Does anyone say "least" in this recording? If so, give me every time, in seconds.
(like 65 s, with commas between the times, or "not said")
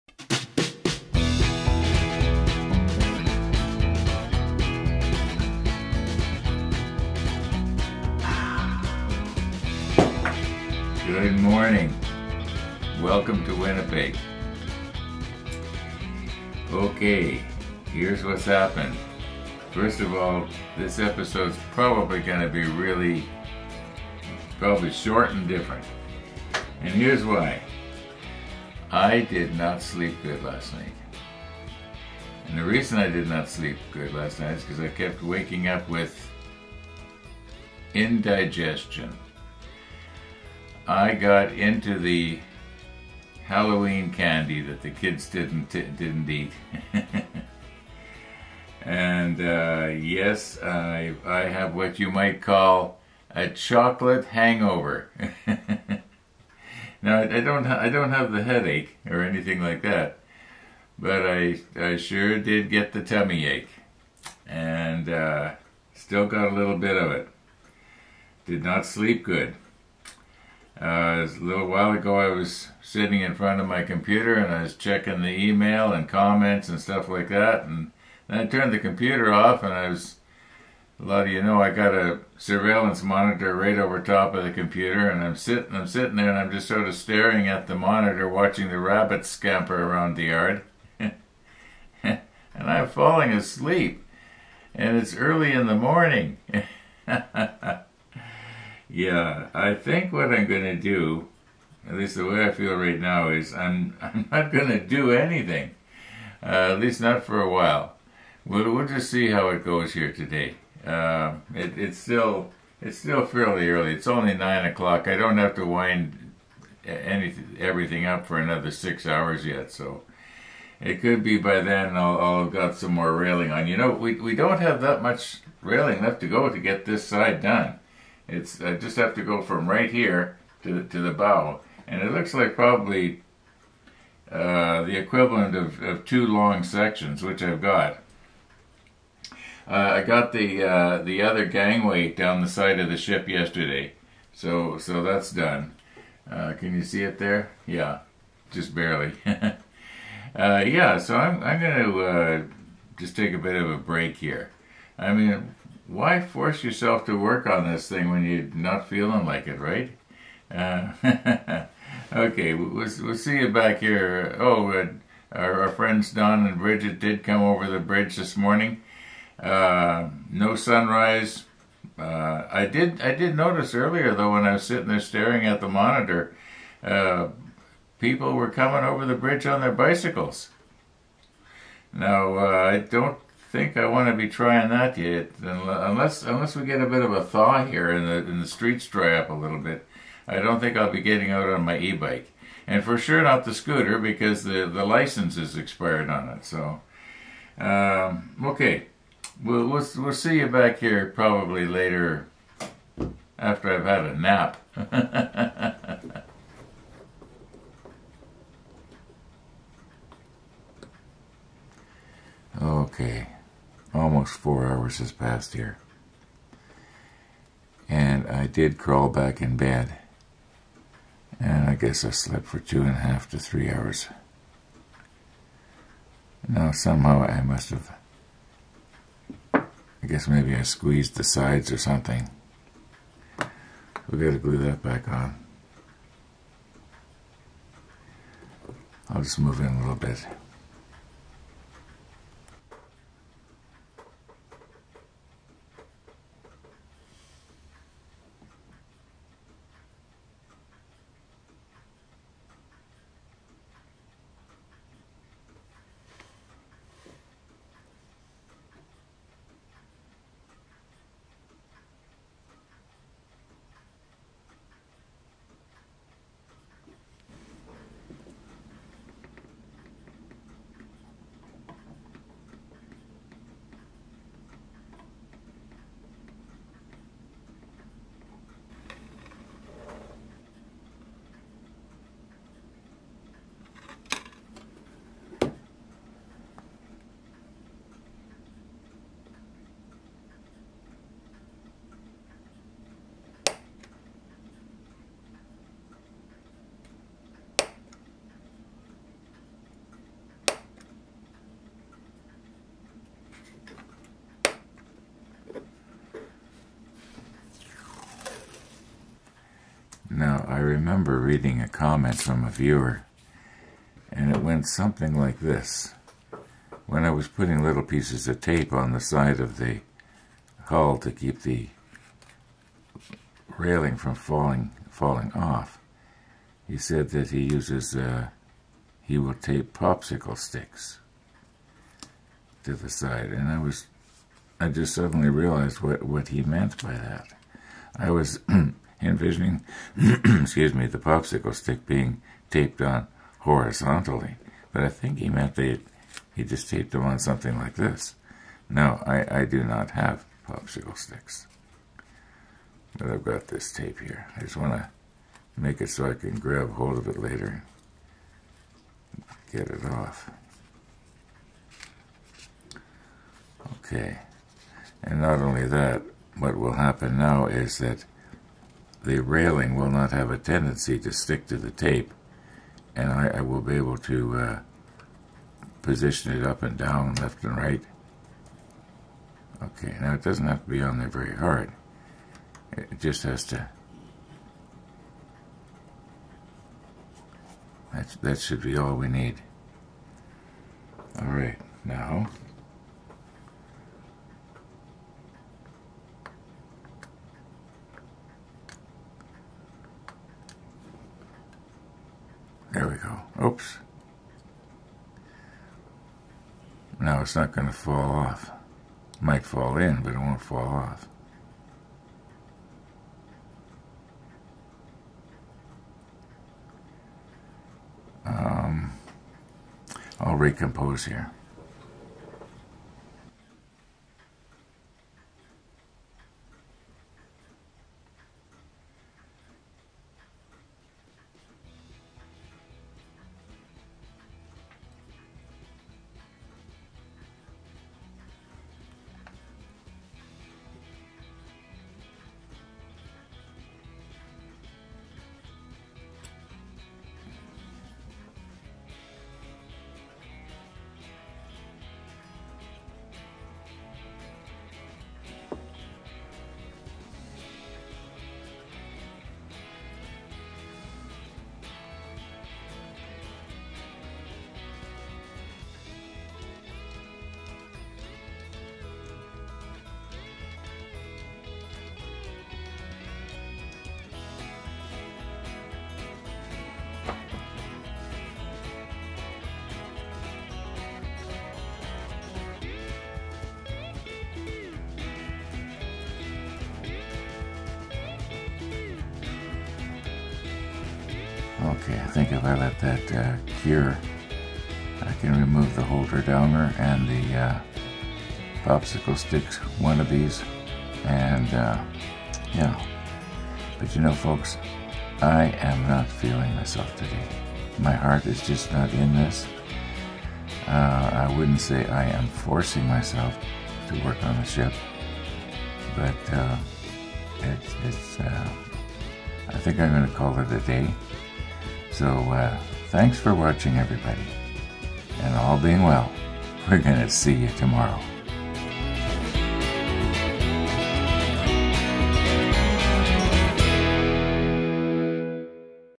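101 s, 106 s.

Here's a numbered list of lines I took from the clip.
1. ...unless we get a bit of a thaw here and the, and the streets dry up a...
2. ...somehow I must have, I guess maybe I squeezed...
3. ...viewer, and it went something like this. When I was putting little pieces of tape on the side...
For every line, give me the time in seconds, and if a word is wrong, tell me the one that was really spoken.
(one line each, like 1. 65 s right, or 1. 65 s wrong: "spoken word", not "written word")
1. 186 s right
2. 226 s right
3. 312 s right.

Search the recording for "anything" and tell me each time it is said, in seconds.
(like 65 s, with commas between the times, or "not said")
59 s, 105 s.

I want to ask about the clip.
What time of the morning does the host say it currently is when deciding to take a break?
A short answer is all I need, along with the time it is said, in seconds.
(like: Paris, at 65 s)
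9 o'clock, at 114 s.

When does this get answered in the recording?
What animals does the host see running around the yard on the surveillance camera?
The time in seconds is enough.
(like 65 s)
88 s.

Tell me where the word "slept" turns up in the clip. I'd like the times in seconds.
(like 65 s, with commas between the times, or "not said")
222 s.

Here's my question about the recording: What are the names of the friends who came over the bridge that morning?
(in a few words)
Don and Bridget.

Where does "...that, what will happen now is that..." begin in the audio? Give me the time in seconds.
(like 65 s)
365 s.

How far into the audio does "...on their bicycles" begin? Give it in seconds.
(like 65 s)
179 s.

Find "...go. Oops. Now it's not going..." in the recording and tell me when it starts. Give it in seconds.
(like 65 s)
402 s.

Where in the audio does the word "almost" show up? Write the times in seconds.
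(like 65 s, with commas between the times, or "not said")
213 s.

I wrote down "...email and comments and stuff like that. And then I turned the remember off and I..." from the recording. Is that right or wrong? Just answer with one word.
wrong.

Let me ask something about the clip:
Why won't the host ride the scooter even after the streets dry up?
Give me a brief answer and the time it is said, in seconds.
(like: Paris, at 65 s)
license is expired, at 194 s.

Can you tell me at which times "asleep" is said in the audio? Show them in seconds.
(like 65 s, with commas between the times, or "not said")
93 s.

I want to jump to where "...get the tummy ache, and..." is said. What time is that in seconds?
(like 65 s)
62 s.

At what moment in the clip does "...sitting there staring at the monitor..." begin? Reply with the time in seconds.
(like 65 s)
174 s.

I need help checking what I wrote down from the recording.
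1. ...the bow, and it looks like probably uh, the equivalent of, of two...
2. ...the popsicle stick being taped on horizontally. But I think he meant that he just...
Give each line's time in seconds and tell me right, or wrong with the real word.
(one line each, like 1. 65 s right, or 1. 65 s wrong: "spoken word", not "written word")
1. 130 s right
2. 340 s right.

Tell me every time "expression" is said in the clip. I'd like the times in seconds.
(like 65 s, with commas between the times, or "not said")
not said.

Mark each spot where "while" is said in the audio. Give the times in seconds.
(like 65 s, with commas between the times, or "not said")
71 s, 107 s.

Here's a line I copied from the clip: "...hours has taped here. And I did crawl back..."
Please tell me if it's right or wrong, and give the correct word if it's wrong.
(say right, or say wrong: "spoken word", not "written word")
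wrong: "passed", not "taped".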